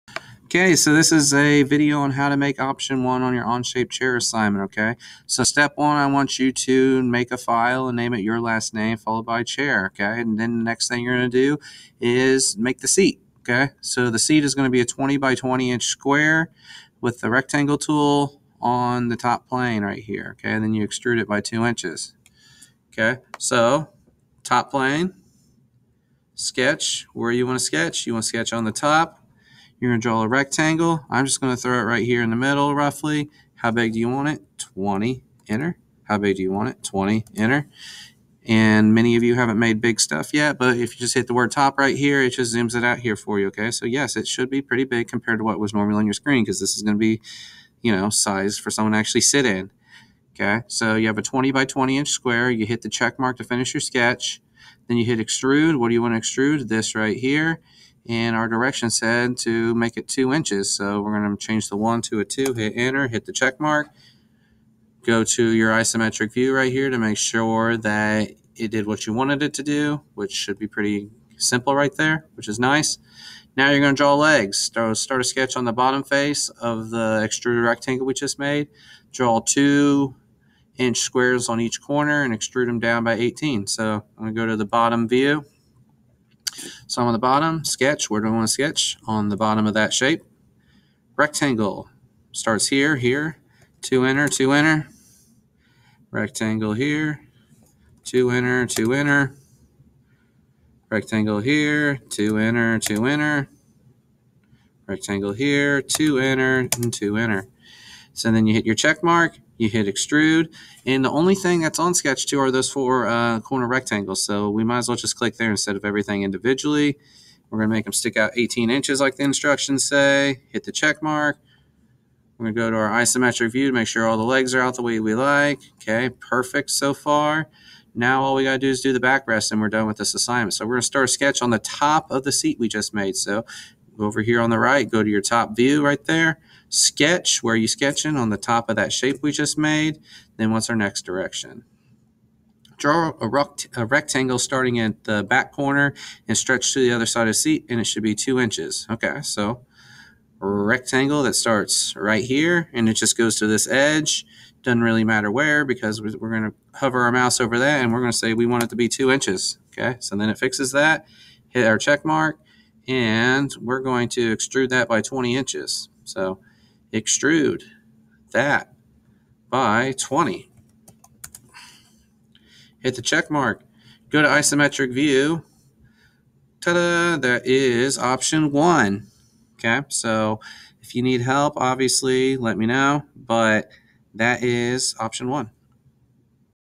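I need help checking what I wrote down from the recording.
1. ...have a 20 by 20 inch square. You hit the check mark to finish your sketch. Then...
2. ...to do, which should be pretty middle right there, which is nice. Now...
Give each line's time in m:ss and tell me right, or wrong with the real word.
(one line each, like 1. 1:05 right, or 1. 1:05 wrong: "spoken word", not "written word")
1. 0:51 right
2. 1:09 wrong: "simple", not "middle".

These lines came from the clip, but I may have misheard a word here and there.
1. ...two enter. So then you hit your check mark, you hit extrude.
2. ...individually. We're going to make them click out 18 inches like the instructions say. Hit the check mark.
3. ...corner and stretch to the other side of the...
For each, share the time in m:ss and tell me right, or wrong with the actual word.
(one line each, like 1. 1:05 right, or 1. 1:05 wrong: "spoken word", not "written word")
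1. 1:46 right
2. 1:56 wrong: "stick", not "click"
3. 2:25 right.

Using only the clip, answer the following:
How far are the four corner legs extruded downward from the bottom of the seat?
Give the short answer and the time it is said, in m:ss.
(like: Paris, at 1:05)
18 inches, at 1:22.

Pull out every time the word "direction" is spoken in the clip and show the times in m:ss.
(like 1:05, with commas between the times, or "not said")
0:58, 2:21.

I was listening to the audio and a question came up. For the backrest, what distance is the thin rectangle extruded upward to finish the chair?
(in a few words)
20 inches.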